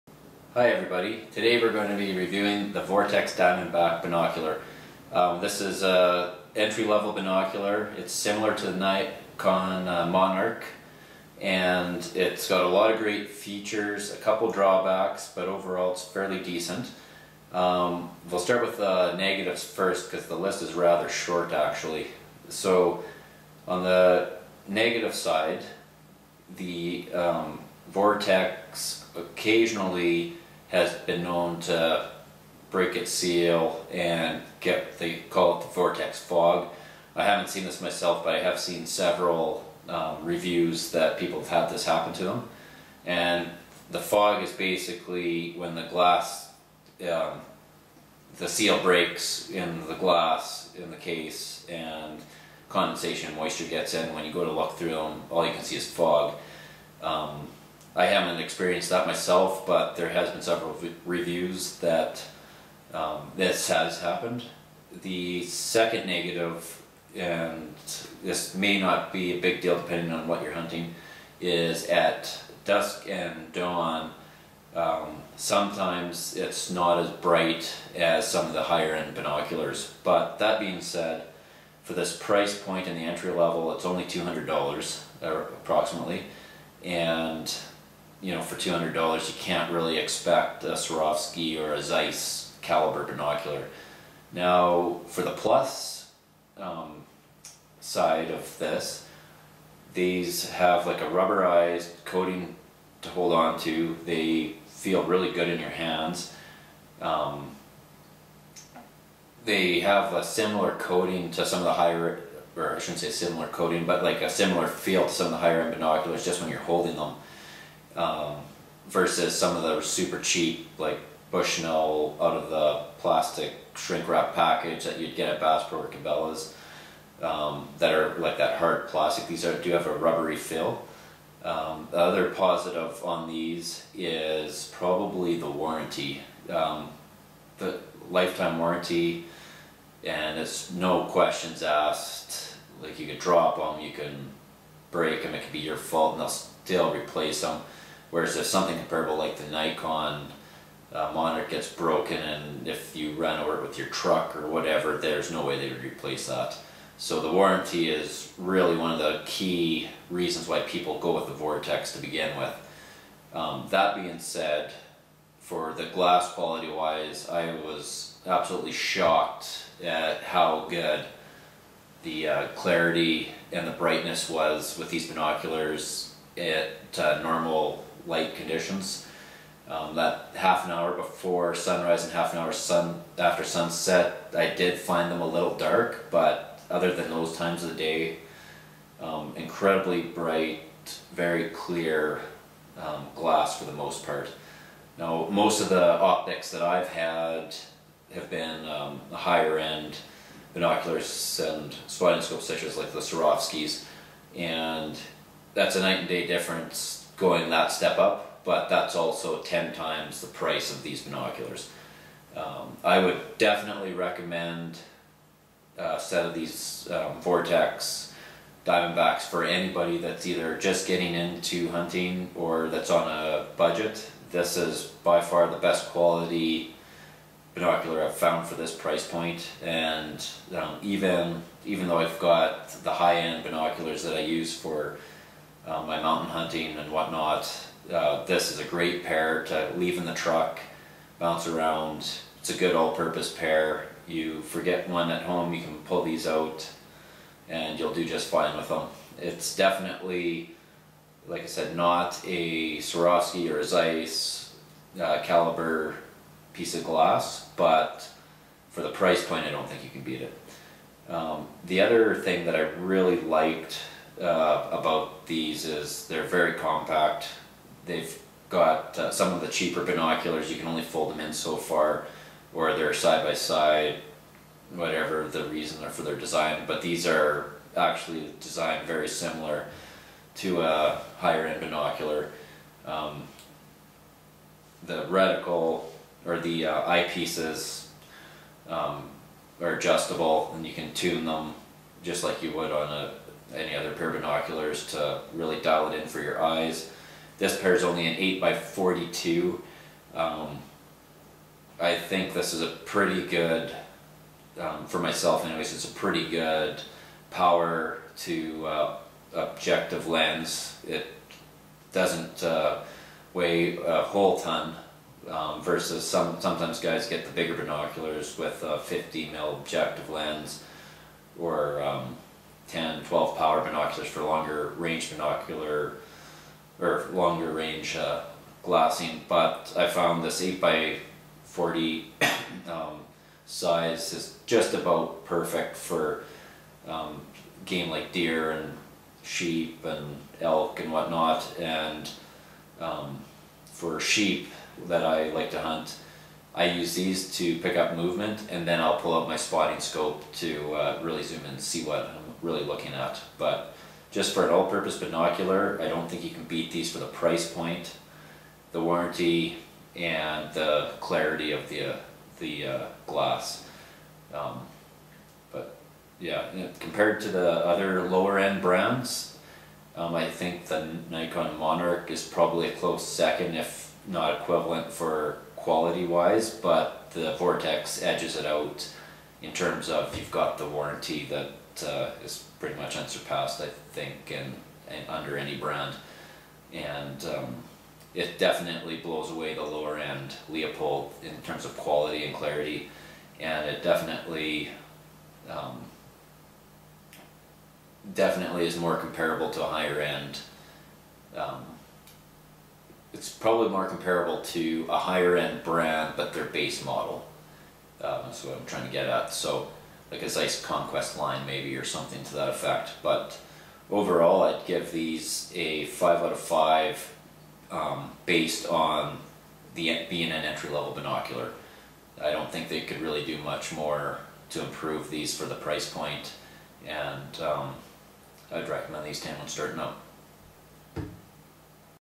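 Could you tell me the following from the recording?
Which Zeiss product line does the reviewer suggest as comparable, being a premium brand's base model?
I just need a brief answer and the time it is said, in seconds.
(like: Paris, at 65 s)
Zeiss Conquest, at 410 s.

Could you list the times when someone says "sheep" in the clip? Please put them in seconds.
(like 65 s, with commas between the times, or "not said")
339 s, 343 s.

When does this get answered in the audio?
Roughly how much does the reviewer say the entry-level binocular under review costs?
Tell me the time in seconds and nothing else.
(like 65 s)
84 s.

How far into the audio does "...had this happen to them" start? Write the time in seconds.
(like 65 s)
41 s.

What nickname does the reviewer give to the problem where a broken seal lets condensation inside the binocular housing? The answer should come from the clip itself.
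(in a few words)
Vortex fog.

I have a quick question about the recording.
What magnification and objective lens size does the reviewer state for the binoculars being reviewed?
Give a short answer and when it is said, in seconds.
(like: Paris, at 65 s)
8x42, at 298 s.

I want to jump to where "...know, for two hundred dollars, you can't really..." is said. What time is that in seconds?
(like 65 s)
88 s.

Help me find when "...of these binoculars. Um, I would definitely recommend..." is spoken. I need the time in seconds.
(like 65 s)
210 s.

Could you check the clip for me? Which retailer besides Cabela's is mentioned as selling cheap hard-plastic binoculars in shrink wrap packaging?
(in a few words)
Bass Pro.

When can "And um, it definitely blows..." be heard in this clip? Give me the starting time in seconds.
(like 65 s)
386 s.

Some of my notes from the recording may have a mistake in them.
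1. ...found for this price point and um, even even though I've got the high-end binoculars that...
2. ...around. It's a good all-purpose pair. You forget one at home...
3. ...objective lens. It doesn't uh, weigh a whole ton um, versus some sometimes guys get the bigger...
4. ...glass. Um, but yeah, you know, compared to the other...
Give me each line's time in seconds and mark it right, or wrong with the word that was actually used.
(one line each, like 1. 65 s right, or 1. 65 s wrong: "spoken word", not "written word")
1. 228 s right
2. 241 s right
3. 309 s right
4. 363 s right.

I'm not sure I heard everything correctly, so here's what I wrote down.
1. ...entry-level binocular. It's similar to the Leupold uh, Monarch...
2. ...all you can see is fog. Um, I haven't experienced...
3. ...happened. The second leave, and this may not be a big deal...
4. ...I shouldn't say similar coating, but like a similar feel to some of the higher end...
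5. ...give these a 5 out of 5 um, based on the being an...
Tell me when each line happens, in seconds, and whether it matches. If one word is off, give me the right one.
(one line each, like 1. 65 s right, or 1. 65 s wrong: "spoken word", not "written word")
1. 6 s wrong: "Nikon", not "Leupold"
2. 55 s right
3. 63 s wrong: "negative", not "leave"
4. 112 s right
5. 414 s right.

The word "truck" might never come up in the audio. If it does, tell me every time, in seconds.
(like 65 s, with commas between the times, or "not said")
153 s, 240 s.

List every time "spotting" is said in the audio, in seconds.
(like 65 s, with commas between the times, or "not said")
201 s, 349 s.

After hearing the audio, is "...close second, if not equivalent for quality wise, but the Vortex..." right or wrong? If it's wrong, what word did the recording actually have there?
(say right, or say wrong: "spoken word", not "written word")
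right.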